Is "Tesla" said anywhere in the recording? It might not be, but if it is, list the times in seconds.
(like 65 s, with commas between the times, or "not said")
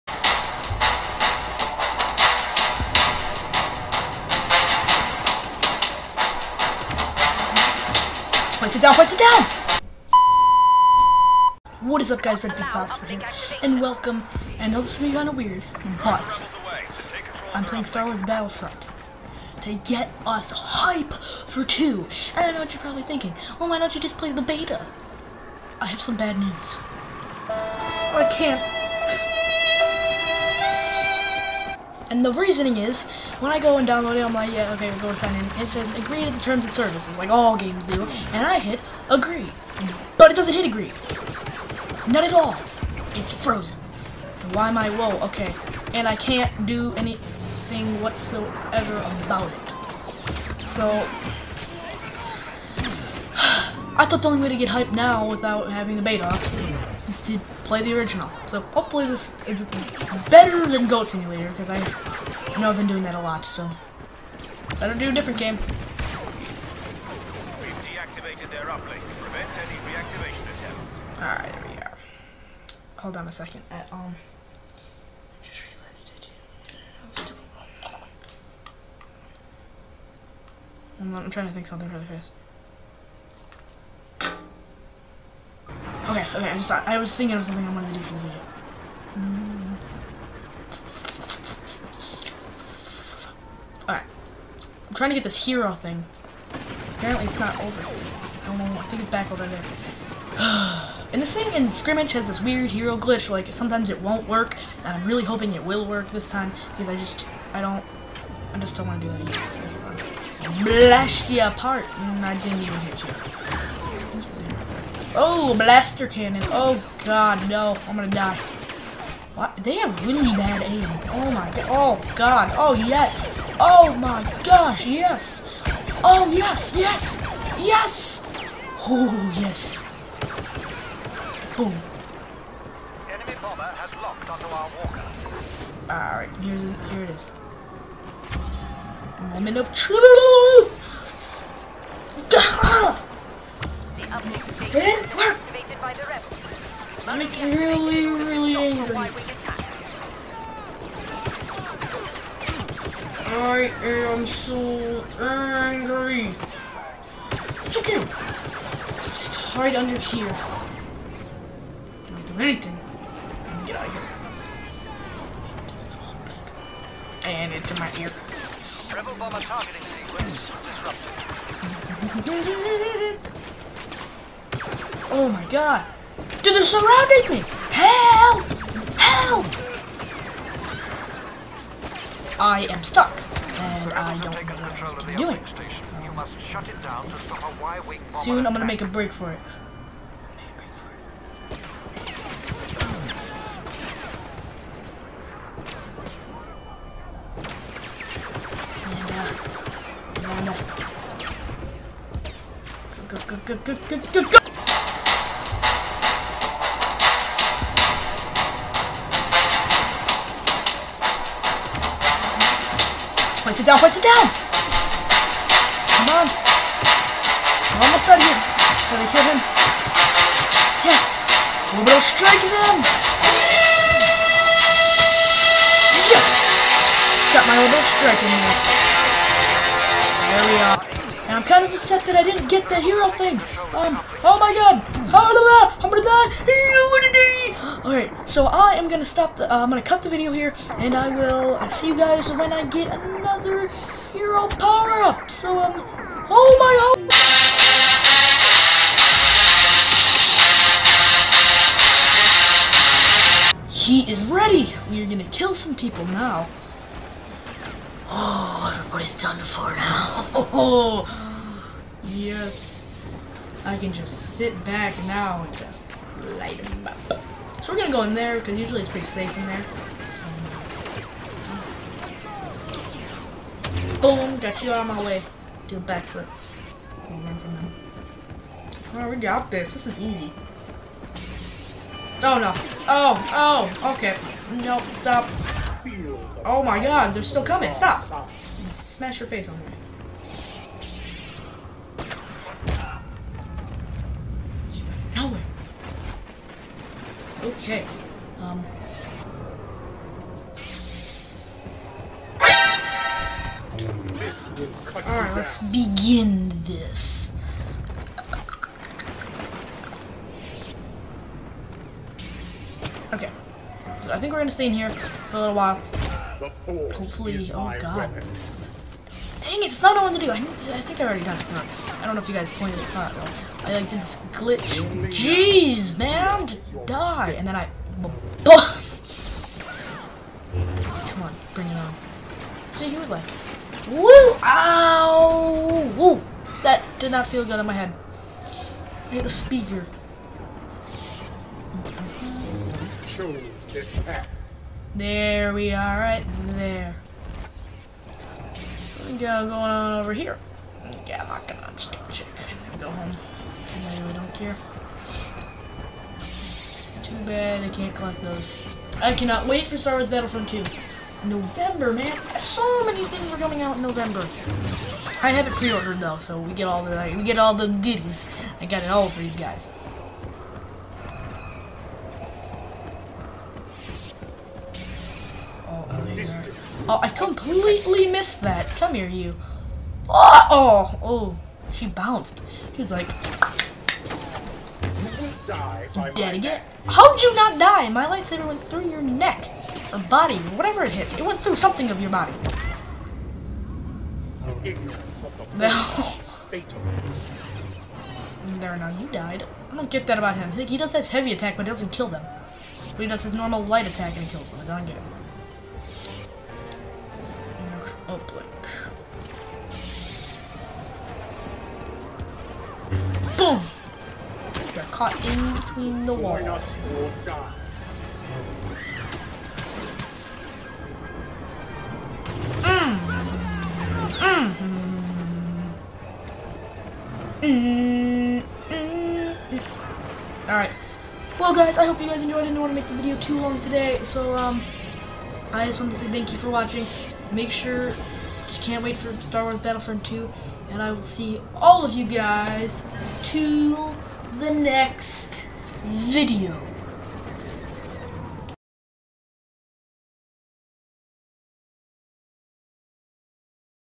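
not said.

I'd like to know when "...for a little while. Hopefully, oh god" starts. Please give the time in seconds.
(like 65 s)
314 s.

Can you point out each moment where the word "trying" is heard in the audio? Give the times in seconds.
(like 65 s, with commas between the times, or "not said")
81 s, 94 s.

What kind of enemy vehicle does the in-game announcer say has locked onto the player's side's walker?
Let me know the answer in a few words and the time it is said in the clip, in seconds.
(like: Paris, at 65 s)
Enemy bomber, at 133 s.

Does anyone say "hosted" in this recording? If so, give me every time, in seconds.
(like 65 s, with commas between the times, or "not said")
not said.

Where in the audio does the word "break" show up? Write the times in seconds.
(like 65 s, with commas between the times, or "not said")
188 s.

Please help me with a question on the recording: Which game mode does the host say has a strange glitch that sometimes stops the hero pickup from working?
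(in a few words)
Scrimmage.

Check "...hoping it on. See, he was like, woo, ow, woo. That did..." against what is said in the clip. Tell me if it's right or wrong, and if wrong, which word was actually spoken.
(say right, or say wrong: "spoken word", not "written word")
wrong: "bring", not "hoping".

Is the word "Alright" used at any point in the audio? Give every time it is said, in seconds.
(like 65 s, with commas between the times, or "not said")
71 s, 93 s, 135 s, 237 s, 305 s, 430 s.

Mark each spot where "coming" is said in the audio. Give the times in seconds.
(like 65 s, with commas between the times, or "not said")
287 s, 363 s.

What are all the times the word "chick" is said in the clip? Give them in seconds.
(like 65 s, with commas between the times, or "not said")
352 s.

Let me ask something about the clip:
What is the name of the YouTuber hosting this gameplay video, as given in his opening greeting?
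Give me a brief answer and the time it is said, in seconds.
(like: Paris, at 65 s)
Redbeak Boxer, at 12 s.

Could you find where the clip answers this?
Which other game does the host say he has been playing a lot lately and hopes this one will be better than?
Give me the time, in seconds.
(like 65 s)
60 s.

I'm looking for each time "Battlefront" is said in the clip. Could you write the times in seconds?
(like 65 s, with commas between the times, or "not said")
18 s, 360 s, 439 s.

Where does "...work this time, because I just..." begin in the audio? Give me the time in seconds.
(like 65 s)
105 s.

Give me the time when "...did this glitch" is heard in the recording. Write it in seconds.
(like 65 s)
323 s.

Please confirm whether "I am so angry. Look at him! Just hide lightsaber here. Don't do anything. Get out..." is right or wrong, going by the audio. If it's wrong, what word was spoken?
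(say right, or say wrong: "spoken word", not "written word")
wrong: "under", not "lightsaber".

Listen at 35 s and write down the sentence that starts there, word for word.
It says, agree to the terms and services, like all games do.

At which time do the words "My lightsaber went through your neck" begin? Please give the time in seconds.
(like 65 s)
387 s.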